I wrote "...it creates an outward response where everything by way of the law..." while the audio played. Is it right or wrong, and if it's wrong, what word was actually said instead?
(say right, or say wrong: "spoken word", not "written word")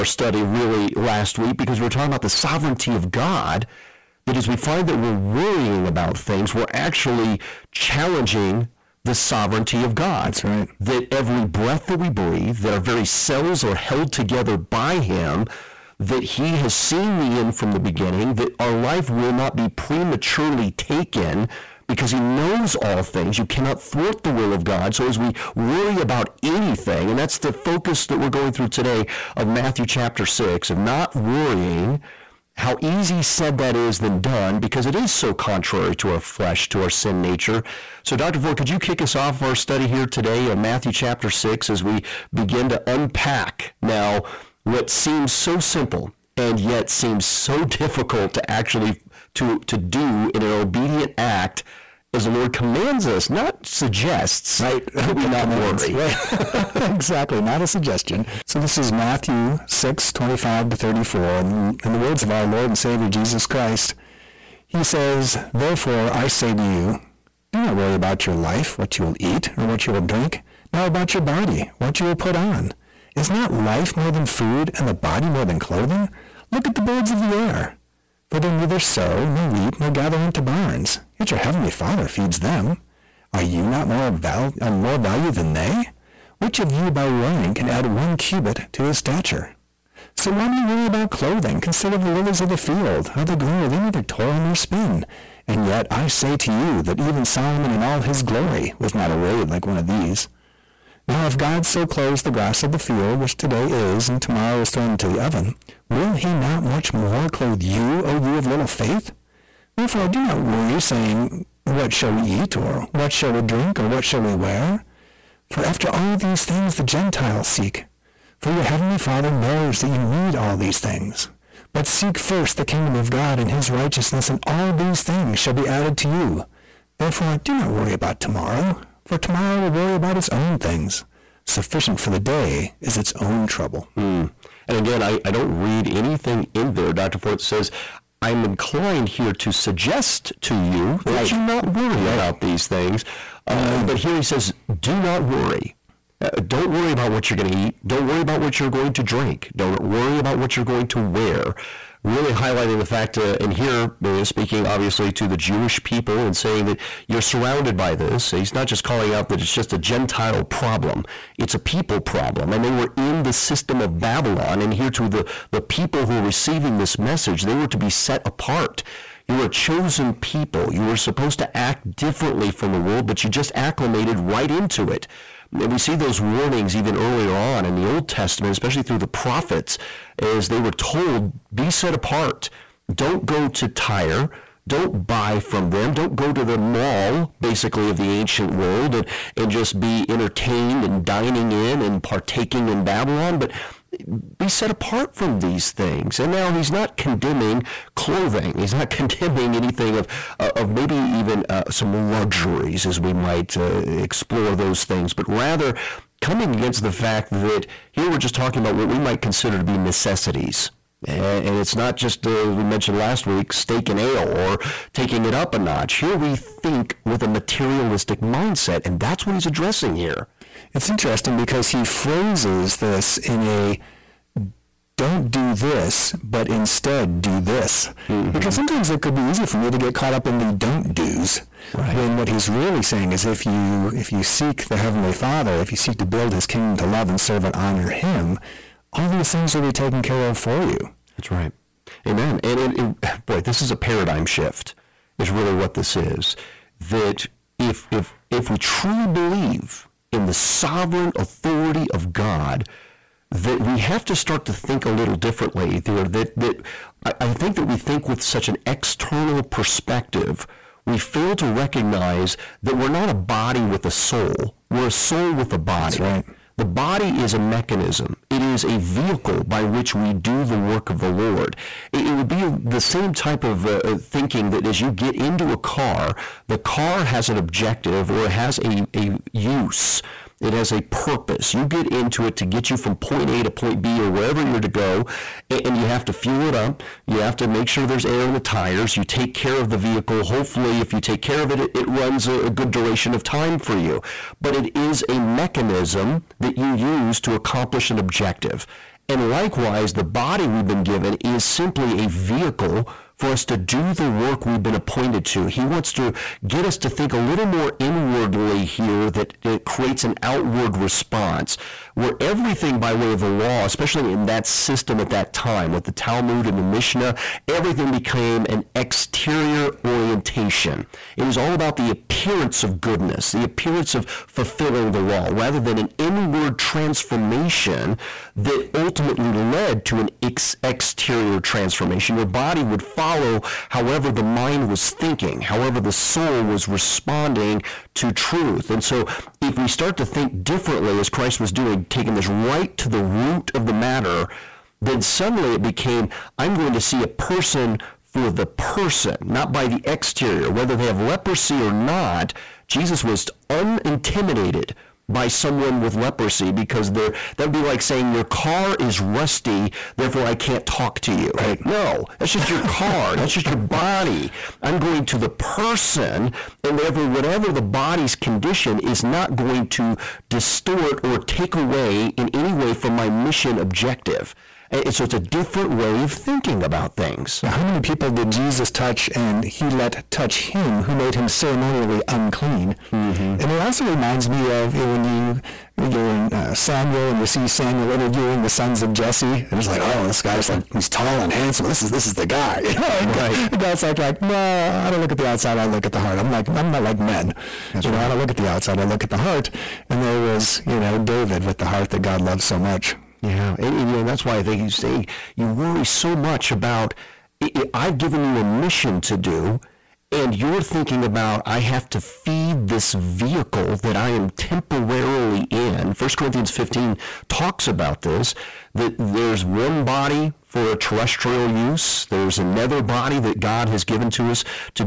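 right.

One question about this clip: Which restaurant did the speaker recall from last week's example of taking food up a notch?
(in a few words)
Steak and Ale.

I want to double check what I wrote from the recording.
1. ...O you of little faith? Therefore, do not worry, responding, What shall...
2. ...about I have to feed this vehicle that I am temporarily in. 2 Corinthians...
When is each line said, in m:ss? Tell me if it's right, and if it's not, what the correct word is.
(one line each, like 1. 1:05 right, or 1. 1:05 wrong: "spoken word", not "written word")
1. 1:48 wrong: "saying", not "responding"
2. 6:51 wrong: "1", not "2".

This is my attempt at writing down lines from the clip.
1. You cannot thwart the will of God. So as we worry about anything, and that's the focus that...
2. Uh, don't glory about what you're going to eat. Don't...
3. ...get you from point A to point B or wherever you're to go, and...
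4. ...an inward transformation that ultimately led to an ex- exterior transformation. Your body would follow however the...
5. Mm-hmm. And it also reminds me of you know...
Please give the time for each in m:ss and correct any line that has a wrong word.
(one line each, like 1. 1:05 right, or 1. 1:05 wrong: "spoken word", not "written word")
1. 0:23 right
2. 2:26 wrong: "worry", not "glory"
3. 4:42 right
4. 5:25 right
5. 6:22 right.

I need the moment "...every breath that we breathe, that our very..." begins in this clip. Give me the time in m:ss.
0:11.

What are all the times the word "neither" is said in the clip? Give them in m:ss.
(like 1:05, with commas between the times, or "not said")
1:18, 1:33.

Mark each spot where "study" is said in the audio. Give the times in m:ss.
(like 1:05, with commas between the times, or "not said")
0:00, 0:39.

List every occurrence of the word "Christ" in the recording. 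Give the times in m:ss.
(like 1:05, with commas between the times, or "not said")
1:03, 5:41.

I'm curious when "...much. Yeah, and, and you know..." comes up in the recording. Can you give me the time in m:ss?
6:42.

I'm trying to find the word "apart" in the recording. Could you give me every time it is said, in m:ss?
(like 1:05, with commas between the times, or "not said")
2:48, 3:01, 3:14.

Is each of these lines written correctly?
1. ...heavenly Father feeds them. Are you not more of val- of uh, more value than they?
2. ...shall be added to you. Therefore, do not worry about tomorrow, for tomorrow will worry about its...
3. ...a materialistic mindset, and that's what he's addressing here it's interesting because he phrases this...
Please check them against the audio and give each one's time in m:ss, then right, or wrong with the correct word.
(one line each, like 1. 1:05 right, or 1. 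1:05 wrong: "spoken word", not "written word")
1. 1:21 right
2. 2:05 right
3. 3:37 right.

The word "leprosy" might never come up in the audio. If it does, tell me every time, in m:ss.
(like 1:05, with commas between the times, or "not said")
5:50, 5:55.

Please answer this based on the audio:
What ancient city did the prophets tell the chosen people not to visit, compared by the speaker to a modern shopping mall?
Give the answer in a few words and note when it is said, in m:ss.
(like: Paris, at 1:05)
Tyre, at 3:03.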